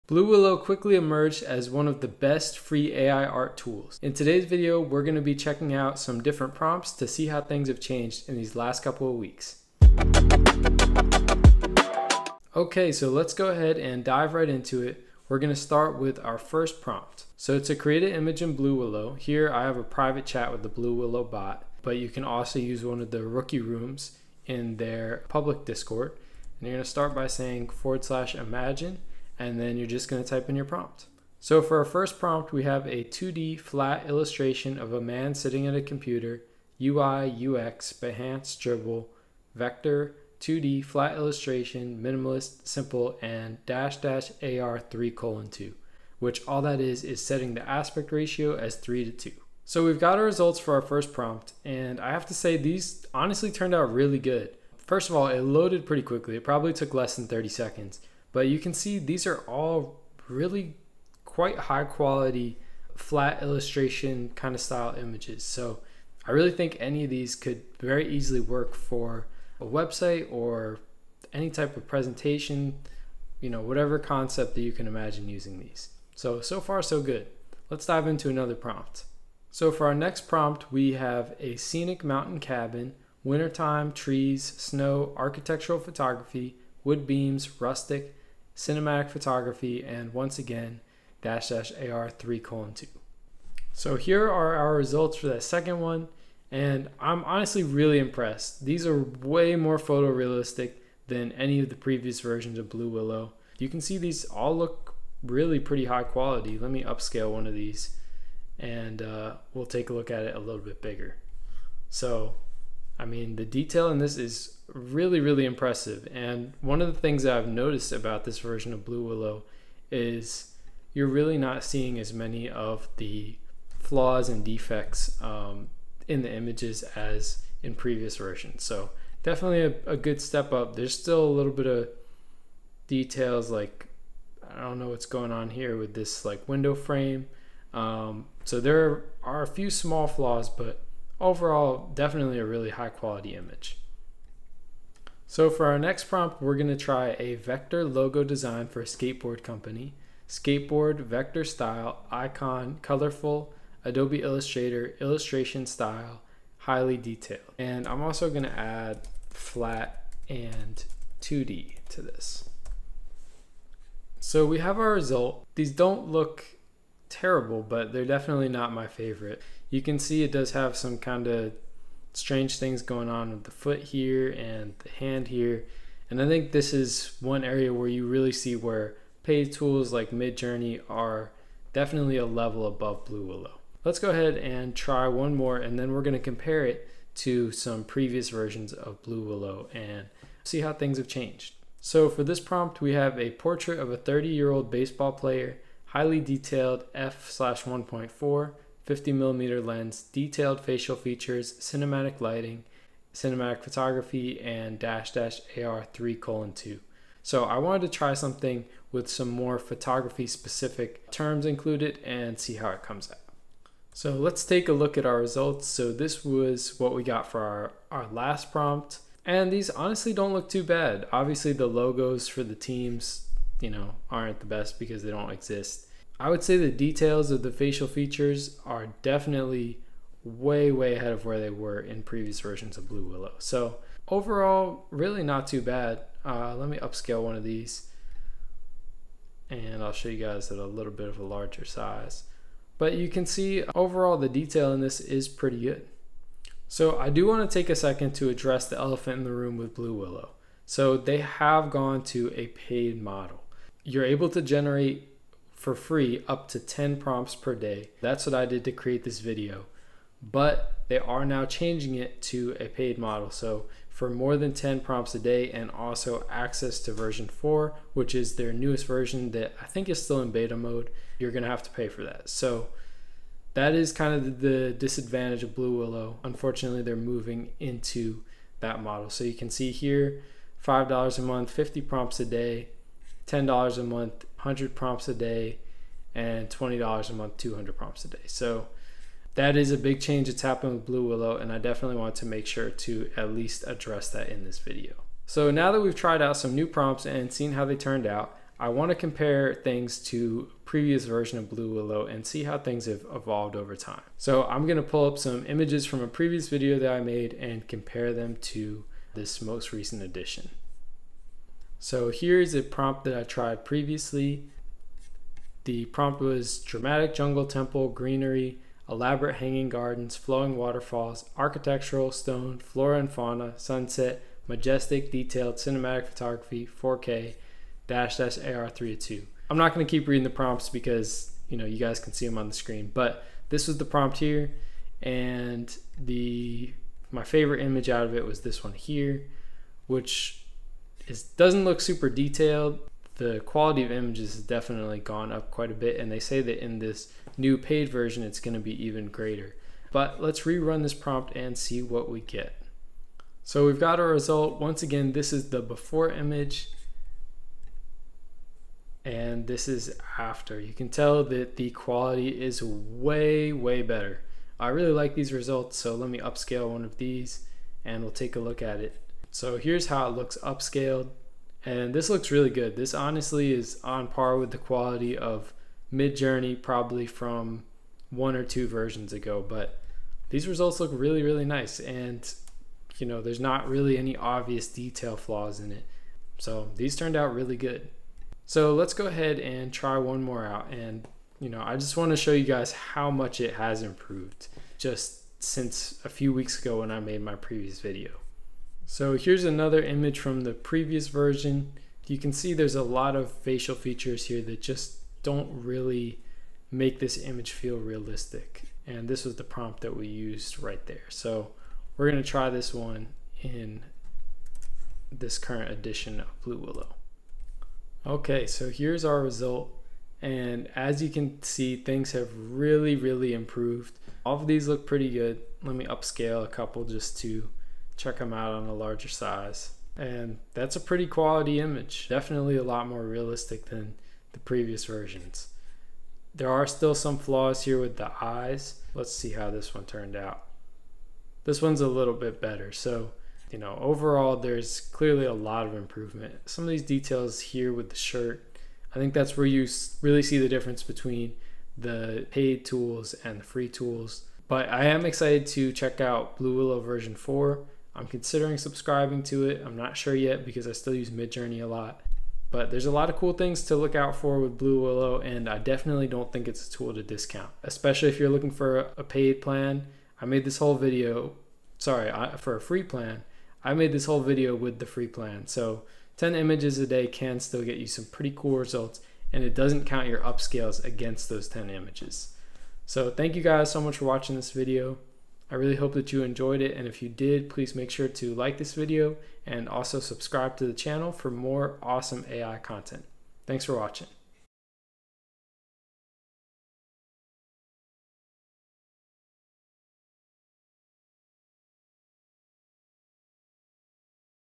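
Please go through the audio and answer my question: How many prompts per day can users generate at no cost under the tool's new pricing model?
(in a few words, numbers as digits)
10.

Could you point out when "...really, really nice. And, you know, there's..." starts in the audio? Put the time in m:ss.
6:20.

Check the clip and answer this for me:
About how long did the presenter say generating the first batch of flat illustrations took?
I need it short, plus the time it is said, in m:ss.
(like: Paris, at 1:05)
less than 30 seconds, at 0:56.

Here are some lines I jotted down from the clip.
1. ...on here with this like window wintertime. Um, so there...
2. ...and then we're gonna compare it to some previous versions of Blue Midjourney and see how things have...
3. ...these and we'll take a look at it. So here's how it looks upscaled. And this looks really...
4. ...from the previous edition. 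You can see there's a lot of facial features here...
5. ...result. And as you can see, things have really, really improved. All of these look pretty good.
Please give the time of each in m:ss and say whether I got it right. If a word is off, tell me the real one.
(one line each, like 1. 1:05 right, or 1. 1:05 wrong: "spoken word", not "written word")
1. 2:15 wrong: "frame", not "wintertime"
2. 3:05 wrong: "Willow", not "Midjourney"
3. 6:06 right
4. 6:40 wrong: "version", not "edition"
5. 6:59 right.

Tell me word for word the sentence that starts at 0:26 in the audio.
And you're going to start by saying forward slash imagine and then you're just going to type in your prompt.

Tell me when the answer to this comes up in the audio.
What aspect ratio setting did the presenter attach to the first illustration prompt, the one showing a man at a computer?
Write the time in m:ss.
0:48.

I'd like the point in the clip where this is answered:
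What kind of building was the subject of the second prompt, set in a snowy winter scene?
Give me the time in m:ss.
1:22.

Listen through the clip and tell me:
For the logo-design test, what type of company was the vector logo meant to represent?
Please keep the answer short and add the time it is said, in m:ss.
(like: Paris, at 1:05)
skateboard company, at 2:28.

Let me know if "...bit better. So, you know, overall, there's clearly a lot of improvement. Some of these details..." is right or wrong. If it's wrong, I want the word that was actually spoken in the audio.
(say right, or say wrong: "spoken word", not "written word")
right.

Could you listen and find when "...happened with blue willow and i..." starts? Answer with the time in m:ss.
4:50.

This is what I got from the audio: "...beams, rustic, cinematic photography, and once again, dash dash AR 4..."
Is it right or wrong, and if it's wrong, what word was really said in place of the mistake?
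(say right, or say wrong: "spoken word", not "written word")
wrong: "3", not "4".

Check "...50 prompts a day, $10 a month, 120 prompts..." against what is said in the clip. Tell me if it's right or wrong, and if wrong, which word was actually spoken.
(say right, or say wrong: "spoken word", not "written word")
wrong: "100", not "120".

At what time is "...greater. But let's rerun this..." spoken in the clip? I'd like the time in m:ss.
5:49.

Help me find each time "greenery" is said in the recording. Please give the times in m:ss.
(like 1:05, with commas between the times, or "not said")
5:17.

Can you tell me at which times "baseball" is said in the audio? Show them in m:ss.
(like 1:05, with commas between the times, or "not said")
3:14.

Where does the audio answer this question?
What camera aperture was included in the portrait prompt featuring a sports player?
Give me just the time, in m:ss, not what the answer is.
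3:16.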